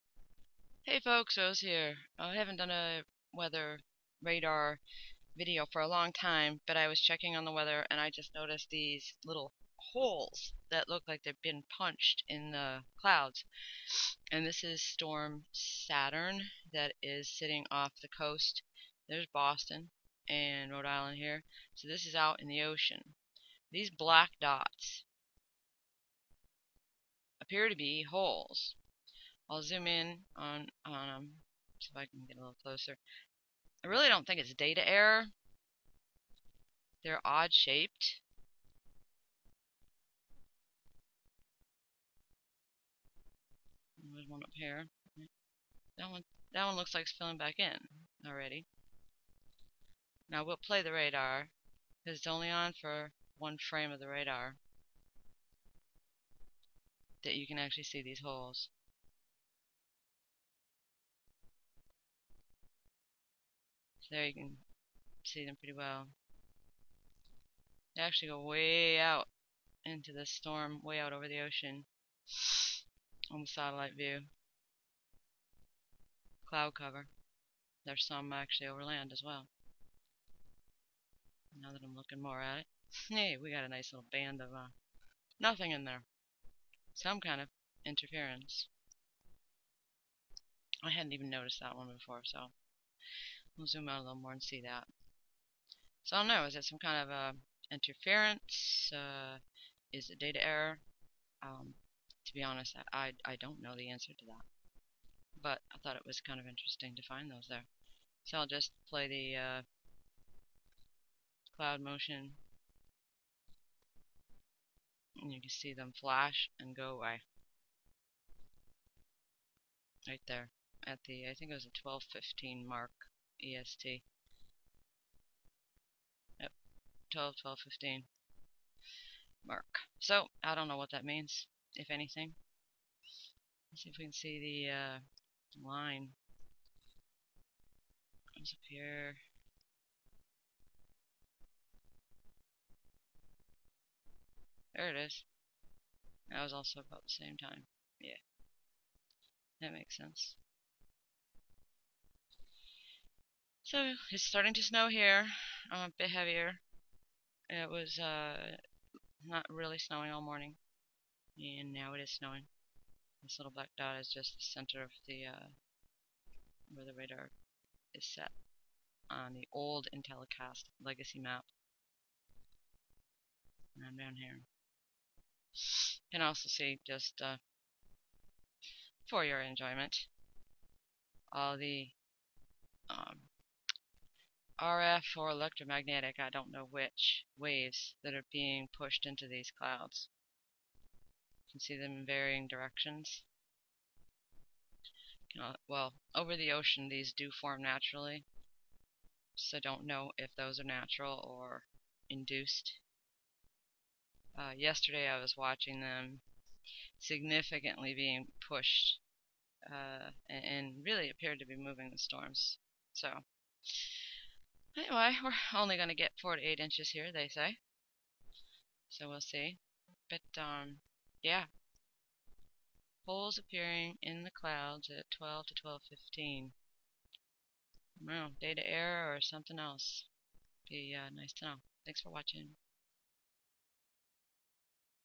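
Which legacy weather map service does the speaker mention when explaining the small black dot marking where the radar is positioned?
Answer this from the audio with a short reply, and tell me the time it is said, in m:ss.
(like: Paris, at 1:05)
Intellicast, at 2:49.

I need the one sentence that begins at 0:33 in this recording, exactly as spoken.
I really don't think it's data error.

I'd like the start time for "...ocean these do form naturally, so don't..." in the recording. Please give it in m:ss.
3:16.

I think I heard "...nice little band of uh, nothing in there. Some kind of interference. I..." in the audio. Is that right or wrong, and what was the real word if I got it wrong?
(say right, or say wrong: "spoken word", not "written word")
right.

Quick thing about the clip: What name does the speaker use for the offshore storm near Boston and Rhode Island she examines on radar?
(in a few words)
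Saturn.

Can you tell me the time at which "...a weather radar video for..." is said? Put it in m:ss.
0:02.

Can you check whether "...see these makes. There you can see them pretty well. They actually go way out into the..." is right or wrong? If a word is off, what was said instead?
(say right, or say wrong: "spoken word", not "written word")
wrong: "holes", not "makes".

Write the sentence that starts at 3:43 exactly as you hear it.
Holes appearing in the clouds at 12 to 12.15.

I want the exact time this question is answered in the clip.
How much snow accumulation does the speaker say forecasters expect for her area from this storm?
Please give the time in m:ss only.
3:36.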